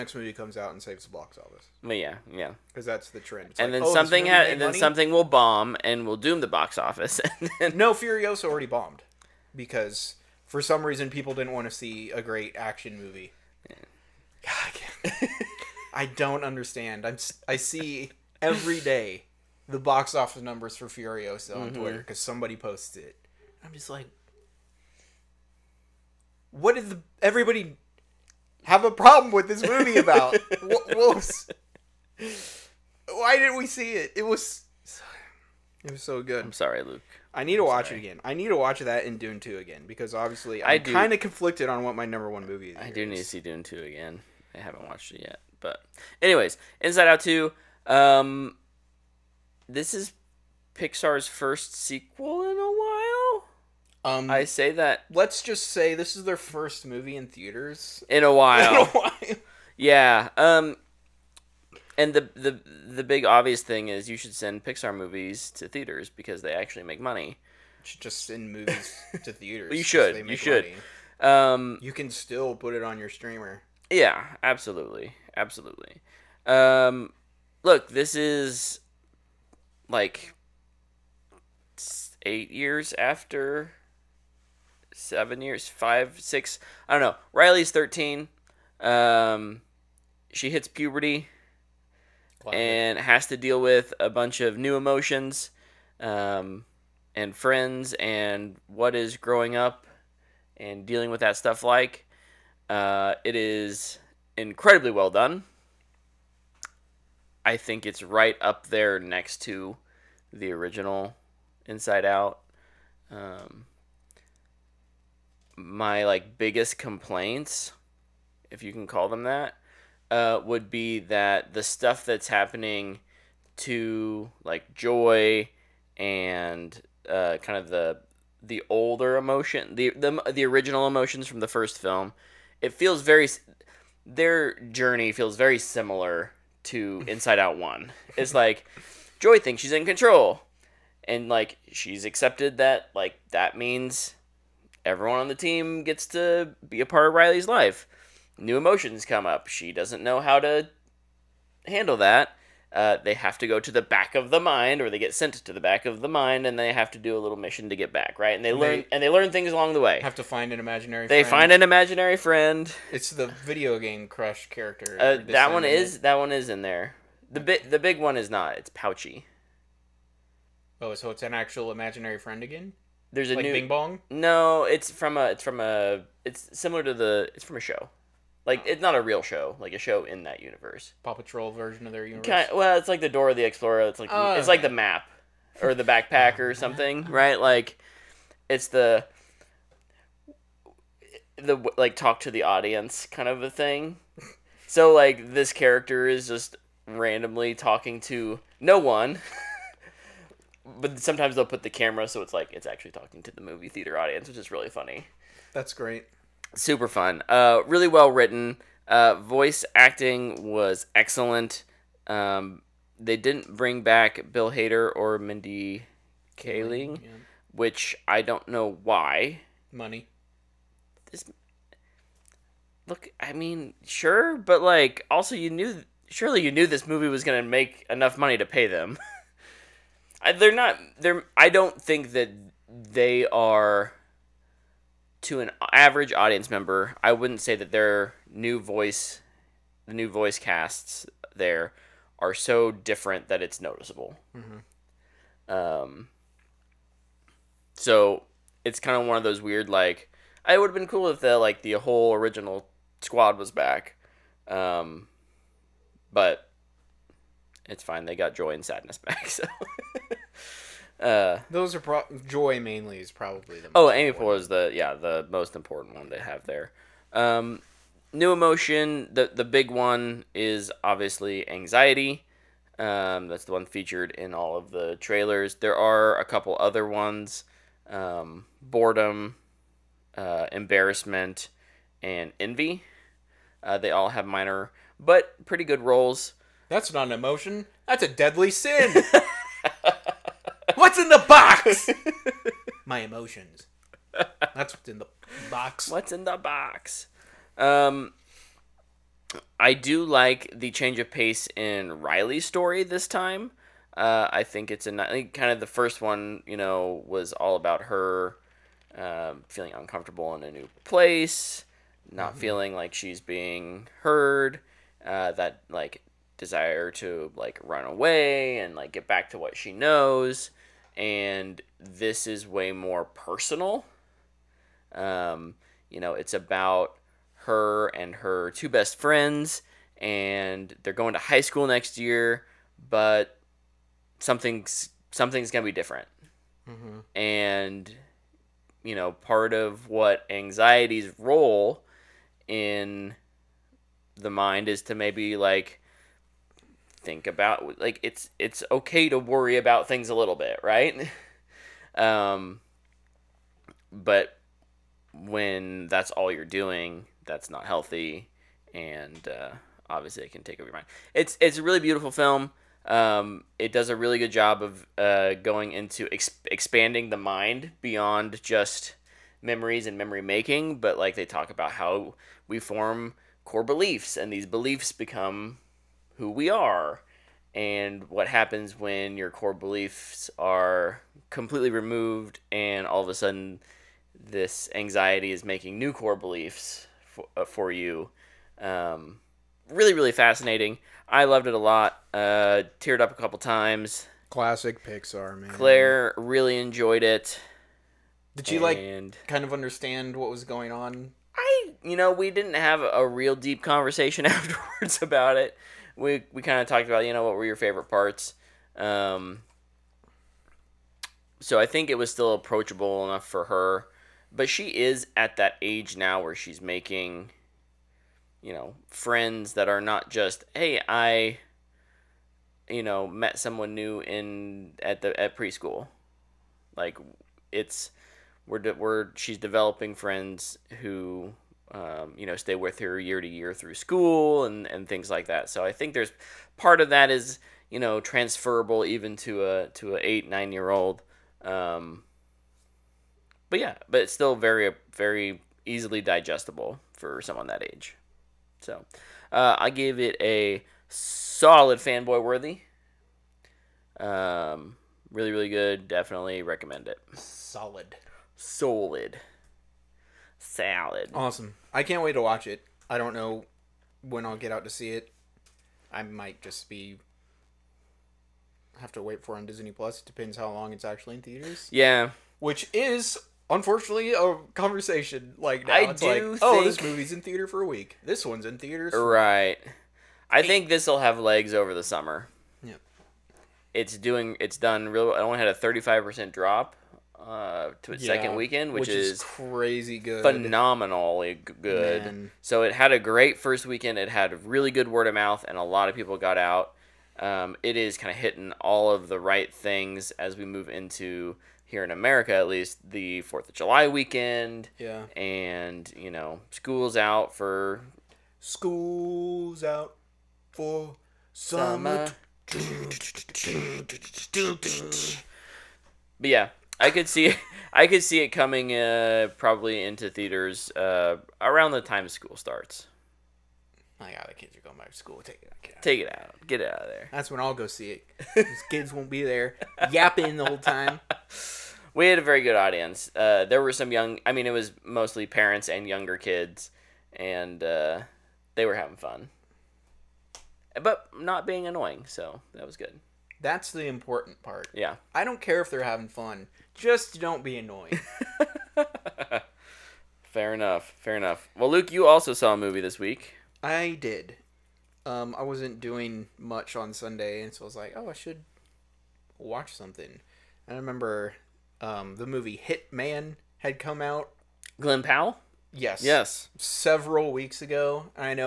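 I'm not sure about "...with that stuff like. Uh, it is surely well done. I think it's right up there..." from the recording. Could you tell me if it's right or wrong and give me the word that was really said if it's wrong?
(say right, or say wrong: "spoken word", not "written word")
wrong: "incredibly", not "surely".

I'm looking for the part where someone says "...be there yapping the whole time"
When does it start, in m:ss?
8:49.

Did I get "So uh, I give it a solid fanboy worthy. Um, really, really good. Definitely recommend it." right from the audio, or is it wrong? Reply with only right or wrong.
right.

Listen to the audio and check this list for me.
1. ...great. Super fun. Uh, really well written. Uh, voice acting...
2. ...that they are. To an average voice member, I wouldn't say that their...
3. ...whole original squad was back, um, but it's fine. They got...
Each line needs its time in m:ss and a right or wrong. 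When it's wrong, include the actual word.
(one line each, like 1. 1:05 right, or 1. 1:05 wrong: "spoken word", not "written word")
1. 3:25 right
2. 3:52 wrong: "audience", not "voice"
3. 4:11 right.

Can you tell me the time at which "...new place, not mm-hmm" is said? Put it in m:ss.
5:10.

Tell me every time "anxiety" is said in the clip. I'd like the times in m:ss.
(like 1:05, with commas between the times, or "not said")
4:31, 5:40, 6:24.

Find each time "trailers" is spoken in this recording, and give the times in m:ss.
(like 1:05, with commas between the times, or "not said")
4:34.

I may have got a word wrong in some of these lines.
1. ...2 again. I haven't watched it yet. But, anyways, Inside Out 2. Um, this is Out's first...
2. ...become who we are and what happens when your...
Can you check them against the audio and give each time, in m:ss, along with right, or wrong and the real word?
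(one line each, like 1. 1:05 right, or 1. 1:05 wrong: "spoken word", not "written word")
1. 0:43 wrong: "Pixar", not "Out"
2. 6:14 right.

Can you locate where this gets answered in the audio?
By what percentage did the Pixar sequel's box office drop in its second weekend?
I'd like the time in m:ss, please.
8:05.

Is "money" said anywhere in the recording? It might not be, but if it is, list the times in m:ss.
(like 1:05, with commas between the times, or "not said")
1:07, 3:39, 3:48.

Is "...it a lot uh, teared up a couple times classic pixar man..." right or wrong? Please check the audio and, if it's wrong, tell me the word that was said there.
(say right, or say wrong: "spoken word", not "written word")
right.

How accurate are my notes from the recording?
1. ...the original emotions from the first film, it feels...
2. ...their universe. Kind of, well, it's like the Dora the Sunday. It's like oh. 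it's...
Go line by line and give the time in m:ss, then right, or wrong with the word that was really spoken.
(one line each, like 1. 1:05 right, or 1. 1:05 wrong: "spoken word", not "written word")
1. 2:10 right
2. 3:01 wrong: "Explorer", not "Sunday".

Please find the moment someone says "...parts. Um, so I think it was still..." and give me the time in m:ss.
6:47.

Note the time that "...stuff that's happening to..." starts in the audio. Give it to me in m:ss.
2:01.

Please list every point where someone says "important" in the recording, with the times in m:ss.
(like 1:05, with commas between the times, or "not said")
4:25, 9:03.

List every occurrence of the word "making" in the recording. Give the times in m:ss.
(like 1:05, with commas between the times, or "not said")
6:10, 6:25, 6:56.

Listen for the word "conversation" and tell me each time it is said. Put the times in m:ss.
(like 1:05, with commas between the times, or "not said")
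6:43, 7:54.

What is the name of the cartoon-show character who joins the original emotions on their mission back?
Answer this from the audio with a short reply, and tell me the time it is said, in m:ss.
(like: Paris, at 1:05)
Pouchy, at 2:48.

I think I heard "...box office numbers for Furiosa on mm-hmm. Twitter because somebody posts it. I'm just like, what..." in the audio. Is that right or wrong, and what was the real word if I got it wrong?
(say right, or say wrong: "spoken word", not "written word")
right.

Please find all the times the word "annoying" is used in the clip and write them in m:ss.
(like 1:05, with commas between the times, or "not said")
9:01, 9:07.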